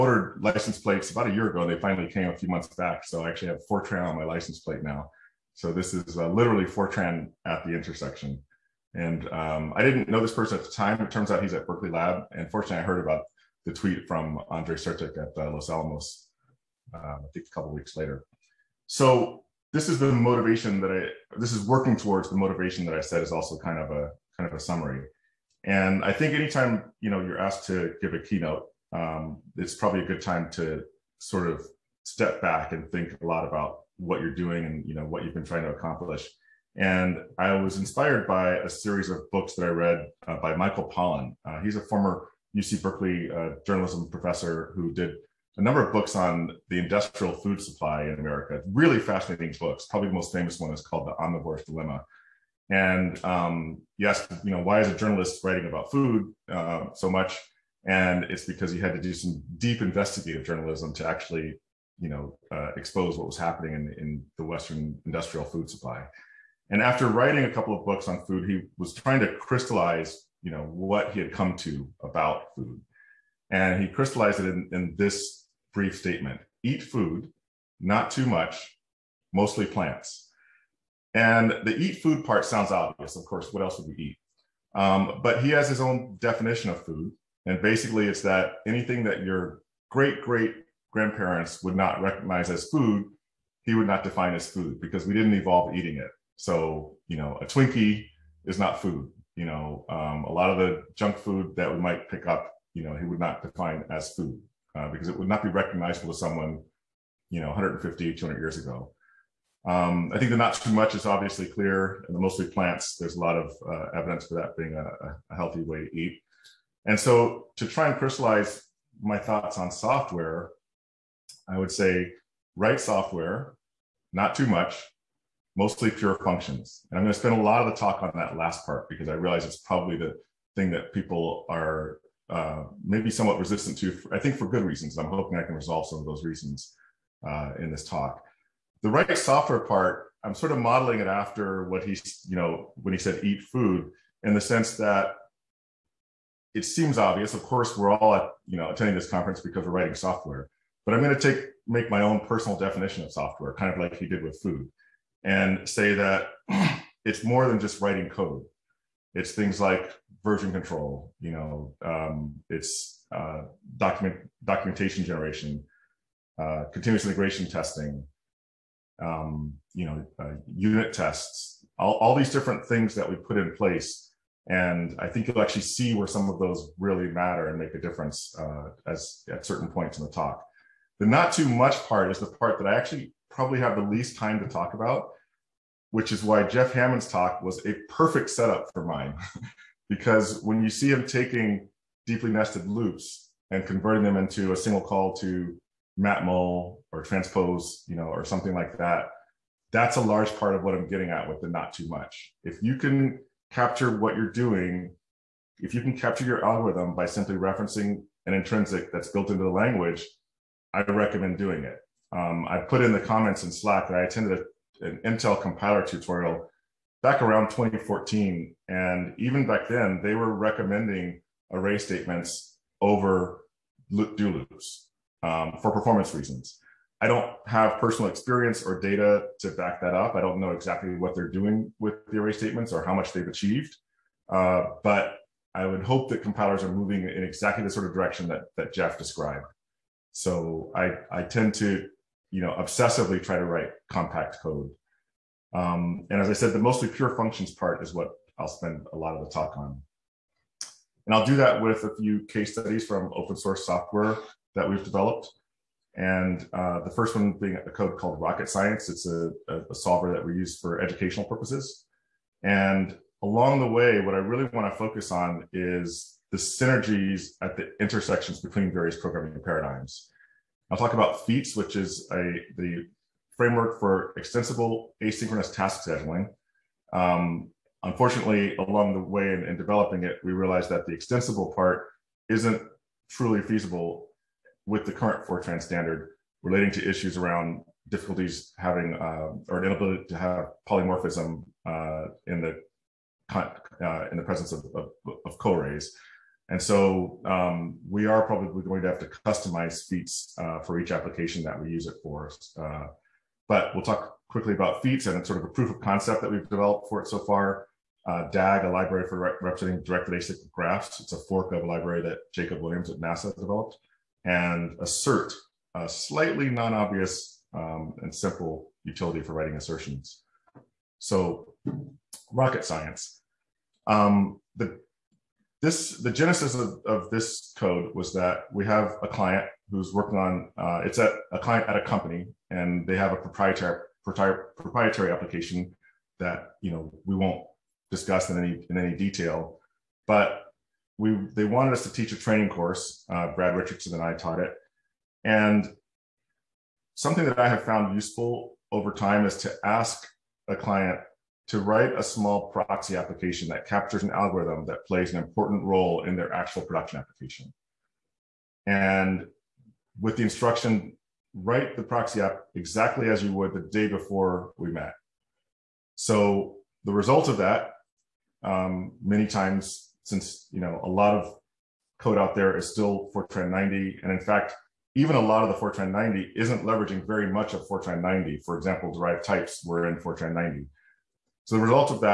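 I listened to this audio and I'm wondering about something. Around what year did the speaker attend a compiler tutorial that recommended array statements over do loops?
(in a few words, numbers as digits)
2014.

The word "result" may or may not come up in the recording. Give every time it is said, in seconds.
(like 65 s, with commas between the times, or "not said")
366 s, 381 s.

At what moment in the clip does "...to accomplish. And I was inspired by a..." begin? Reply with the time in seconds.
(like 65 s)
35 s.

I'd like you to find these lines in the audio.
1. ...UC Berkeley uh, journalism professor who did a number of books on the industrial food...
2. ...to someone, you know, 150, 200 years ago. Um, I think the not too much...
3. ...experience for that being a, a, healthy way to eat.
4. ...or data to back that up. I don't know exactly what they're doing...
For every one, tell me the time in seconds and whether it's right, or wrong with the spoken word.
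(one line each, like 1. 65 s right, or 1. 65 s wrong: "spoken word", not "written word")
1. 42 s right
2. 106 s right
3. 113 s wrong: "evidence", not "experience"
4. 228 s right.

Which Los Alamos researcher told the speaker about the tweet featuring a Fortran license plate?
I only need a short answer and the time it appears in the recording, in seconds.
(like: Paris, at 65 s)
Andre Sertic, at 14 s.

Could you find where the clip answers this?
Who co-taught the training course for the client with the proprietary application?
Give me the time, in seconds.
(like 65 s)
343 s.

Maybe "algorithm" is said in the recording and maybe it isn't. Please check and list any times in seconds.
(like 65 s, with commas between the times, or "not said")
206 s, 354 s.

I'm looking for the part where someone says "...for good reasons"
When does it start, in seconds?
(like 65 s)
134 s.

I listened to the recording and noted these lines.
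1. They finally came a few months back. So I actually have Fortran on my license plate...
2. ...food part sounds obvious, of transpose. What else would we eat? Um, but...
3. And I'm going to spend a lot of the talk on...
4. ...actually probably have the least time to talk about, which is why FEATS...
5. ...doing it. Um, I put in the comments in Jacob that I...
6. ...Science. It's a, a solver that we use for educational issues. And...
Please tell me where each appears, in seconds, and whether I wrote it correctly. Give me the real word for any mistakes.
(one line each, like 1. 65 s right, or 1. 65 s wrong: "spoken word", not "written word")
1. 1 s right
2. 81 s wrong: "course", not "transpose"
3. 126 s right
4. 182 s wrong: "Jeff", not "FEATS"
5. 211 s wrong: "Slack", not "Jacob"
6. 258 s wrong: "purposes", not "issues".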